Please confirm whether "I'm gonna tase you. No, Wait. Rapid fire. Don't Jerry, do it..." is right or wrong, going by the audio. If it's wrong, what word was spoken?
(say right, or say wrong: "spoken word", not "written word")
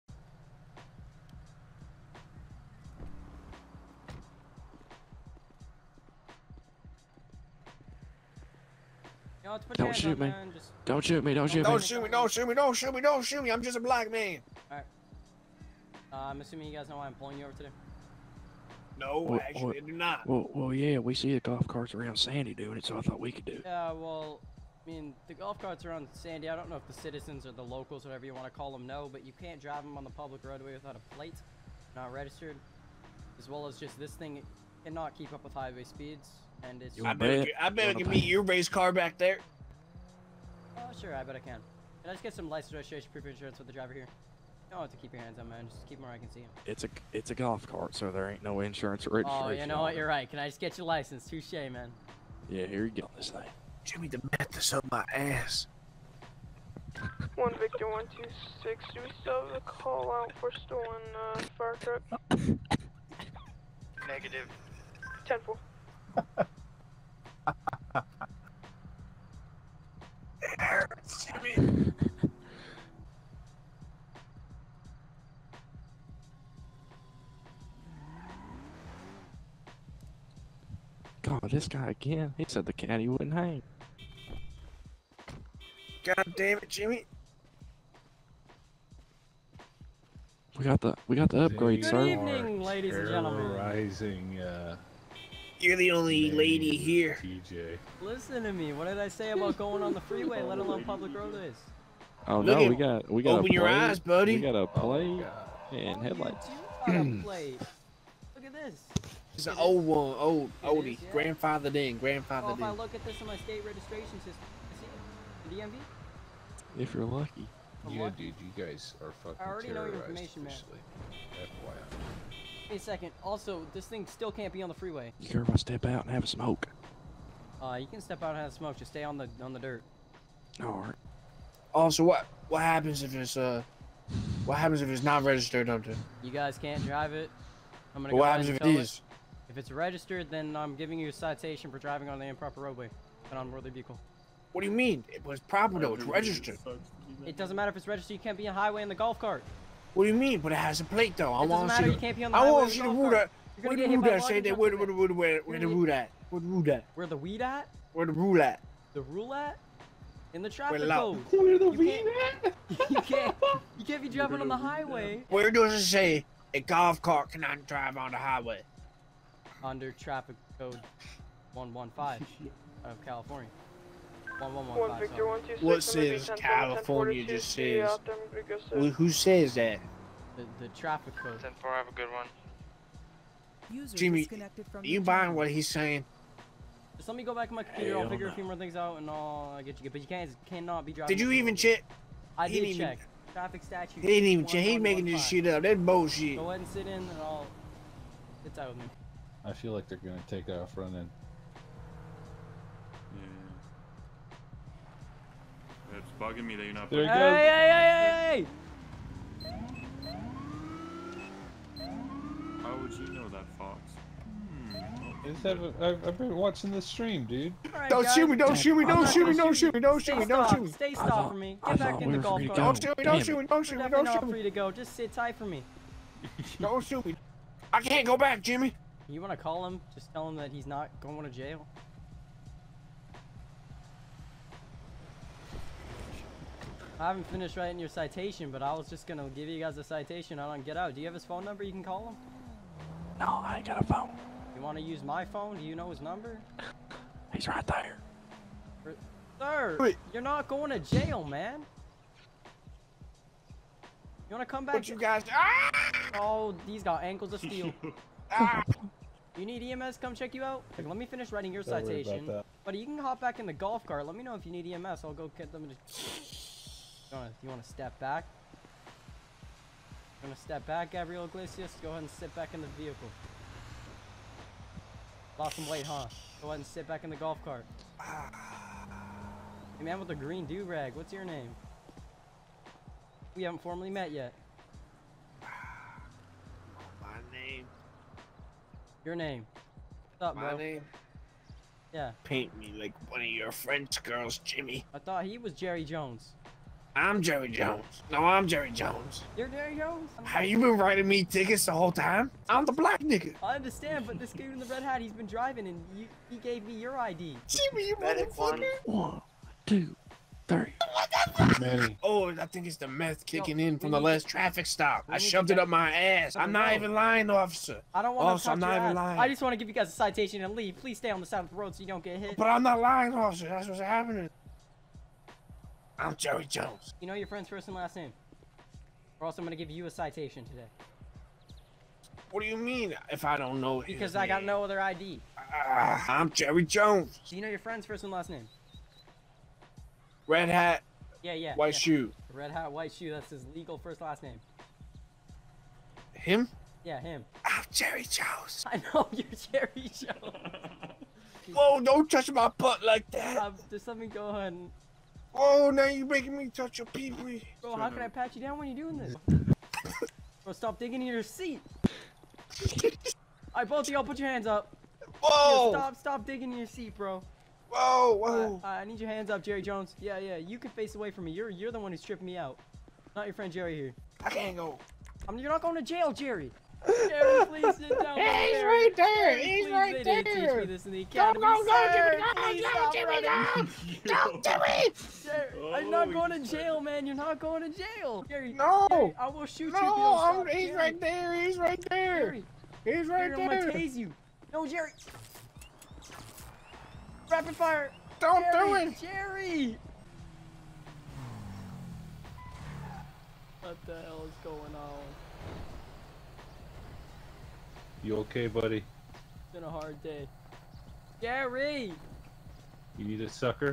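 wrong: "Jerry", not "Wait".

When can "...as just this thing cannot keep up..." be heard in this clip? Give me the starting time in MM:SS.
00:33.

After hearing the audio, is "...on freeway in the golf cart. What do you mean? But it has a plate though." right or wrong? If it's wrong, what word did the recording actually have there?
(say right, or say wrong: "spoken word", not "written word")
wrong: "highway", not "freeway".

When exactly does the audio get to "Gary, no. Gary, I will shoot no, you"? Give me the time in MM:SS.
06:28.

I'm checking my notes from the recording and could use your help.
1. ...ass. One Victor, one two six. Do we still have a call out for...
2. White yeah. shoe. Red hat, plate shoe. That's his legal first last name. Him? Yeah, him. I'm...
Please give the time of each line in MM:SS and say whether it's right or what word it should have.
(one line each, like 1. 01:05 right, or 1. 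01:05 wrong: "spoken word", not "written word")
1. 00:55 right
2. 05:41 wrong: "white", not "plate".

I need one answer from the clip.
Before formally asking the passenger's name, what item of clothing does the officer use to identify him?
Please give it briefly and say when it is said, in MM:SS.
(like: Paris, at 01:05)
green do-rag, at 04:40.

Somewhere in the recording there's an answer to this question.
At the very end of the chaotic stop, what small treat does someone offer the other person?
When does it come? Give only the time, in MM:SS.
06:53.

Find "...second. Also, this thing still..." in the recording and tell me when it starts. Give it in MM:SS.
02:02.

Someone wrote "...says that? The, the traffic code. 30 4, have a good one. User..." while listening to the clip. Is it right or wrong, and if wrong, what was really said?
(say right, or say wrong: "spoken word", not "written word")
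wrong: "10", not "30".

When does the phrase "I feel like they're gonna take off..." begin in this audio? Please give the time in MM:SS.
03:19.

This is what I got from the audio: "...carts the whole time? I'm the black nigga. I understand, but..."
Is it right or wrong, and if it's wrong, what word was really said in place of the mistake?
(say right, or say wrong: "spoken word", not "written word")
wrong: "tickets", not "carts".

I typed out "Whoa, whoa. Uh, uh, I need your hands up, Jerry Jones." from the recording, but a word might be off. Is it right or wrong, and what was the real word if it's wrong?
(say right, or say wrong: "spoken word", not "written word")
right.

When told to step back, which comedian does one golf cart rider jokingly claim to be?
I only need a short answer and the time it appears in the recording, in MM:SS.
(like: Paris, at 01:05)
Gabriel Iglesias, at 04:30.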